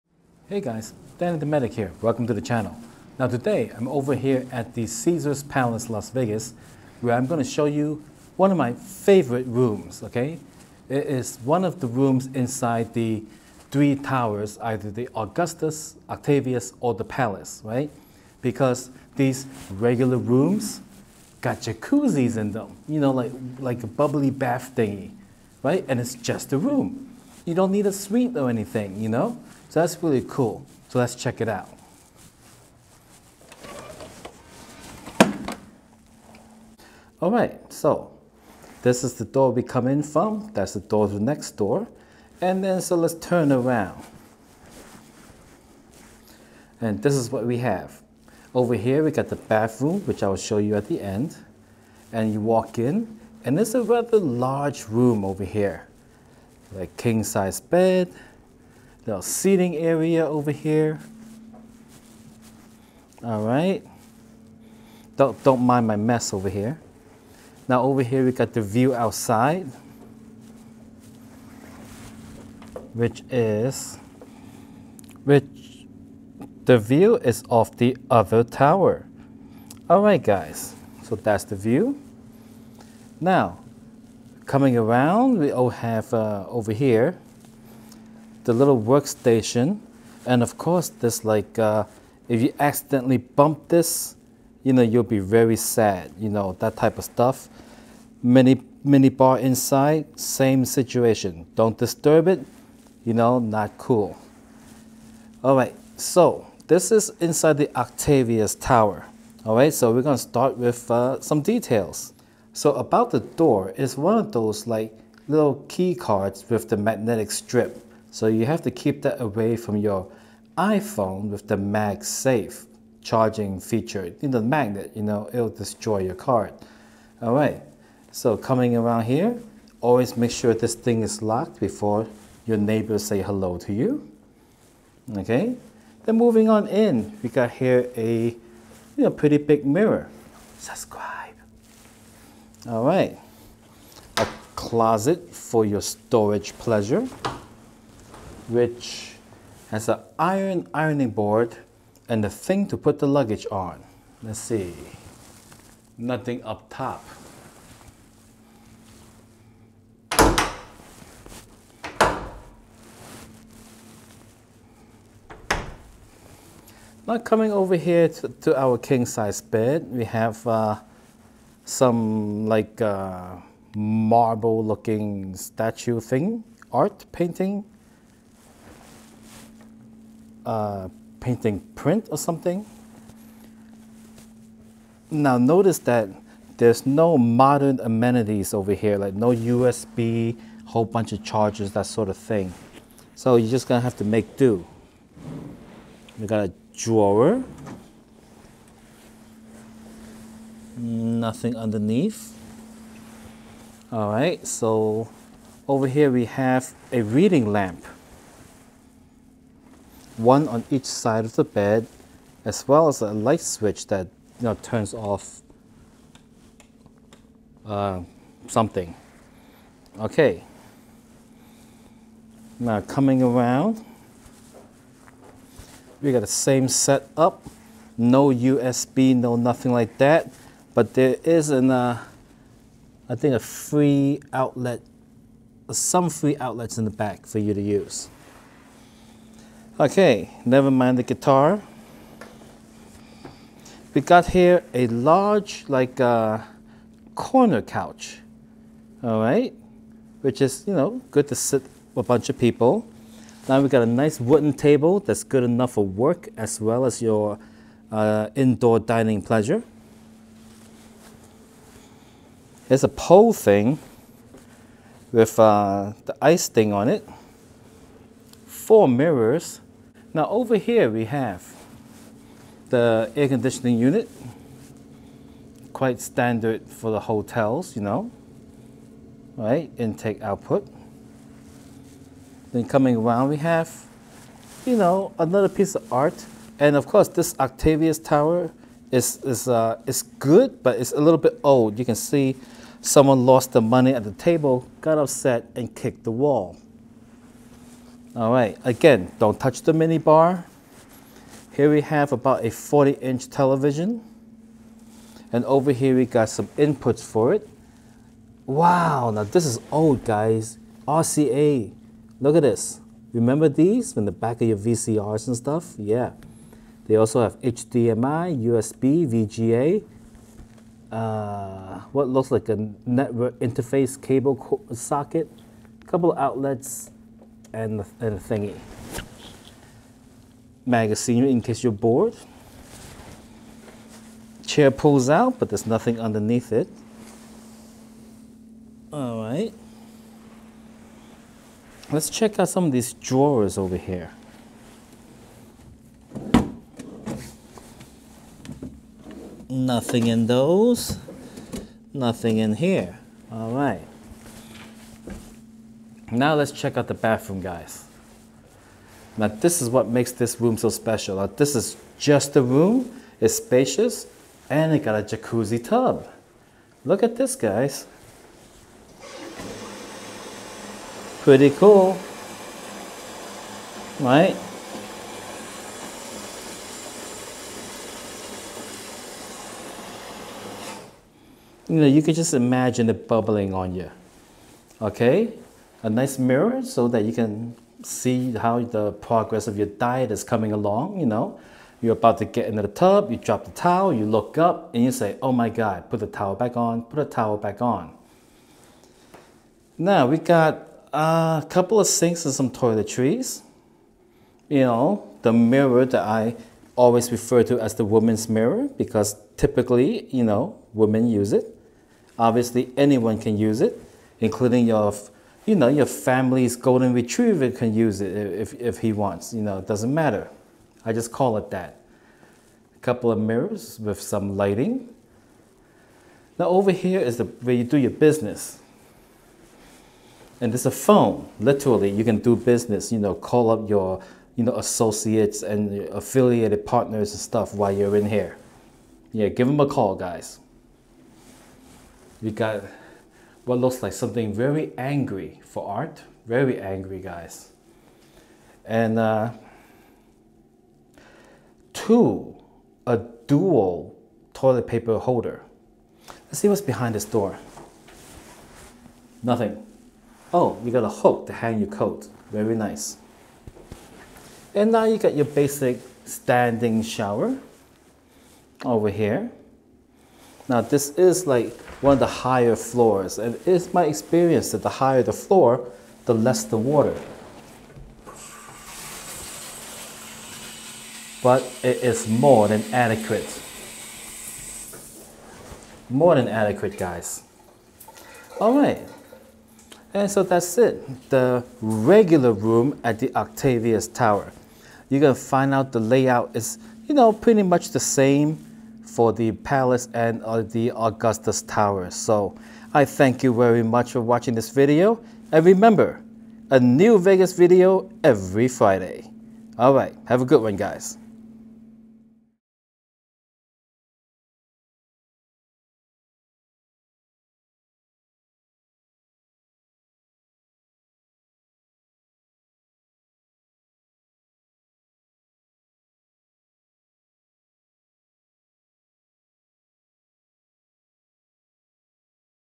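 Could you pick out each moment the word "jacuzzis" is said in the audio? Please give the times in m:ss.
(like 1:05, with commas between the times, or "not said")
0:21, 6:05.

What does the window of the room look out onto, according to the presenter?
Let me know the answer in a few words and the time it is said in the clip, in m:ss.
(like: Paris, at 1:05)
The other tower, at 1:17.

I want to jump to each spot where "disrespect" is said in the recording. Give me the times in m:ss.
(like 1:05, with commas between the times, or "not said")
not said.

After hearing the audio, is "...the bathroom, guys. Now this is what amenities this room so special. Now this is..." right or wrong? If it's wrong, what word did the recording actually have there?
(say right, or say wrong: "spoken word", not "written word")
wrong: "makes", not "amenities".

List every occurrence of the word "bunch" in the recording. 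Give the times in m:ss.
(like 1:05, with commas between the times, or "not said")
3:10, 4:12.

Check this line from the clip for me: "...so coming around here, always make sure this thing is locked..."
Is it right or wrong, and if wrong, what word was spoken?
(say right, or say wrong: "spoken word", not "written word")
right.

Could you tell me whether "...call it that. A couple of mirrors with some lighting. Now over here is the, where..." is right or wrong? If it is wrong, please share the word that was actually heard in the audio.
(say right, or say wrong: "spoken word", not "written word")
right.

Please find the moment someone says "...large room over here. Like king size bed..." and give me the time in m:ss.
0:54.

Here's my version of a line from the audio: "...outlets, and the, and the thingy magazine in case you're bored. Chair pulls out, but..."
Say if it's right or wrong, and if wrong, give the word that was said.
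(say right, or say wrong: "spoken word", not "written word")
right.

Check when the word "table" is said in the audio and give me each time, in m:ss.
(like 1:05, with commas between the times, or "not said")
4:14, 4:54.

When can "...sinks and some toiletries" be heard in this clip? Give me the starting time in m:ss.
6:41.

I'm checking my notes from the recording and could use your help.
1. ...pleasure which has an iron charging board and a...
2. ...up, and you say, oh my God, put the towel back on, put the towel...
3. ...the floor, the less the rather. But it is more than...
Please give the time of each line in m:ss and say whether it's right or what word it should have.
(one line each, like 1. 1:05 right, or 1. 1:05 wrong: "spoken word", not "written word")
1. 2:26 wrong: "ironing", not "charging"
2. 6:34 right
3. 7:55 wrong: "water", not "rather".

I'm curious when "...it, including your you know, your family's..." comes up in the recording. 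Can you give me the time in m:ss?
6:53.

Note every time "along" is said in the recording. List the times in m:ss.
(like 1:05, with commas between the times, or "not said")
6:30.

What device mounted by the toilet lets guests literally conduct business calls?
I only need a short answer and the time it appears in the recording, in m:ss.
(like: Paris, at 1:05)
A phone, at 7:10.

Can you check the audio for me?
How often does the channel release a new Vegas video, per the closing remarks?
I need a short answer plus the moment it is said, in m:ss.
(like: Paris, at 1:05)
Every Friday, at 8:28.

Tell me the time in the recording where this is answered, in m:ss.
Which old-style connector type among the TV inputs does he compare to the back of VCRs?
5:10.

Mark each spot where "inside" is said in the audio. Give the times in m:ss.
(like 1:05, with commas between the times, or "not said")
0:12, 1:39, 1:47.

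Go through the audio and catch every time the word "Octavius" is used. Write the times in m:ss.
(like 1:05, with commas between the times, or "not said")
0:16, 1:47, 4:47, 8:13.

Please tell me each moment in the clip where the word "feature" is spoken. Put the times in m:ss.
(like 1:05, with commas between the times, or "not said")
2:03.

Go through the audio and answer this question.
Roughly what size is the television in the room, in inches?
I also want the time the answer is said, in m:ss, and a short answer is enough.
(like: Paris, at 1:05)
40, at 5:02.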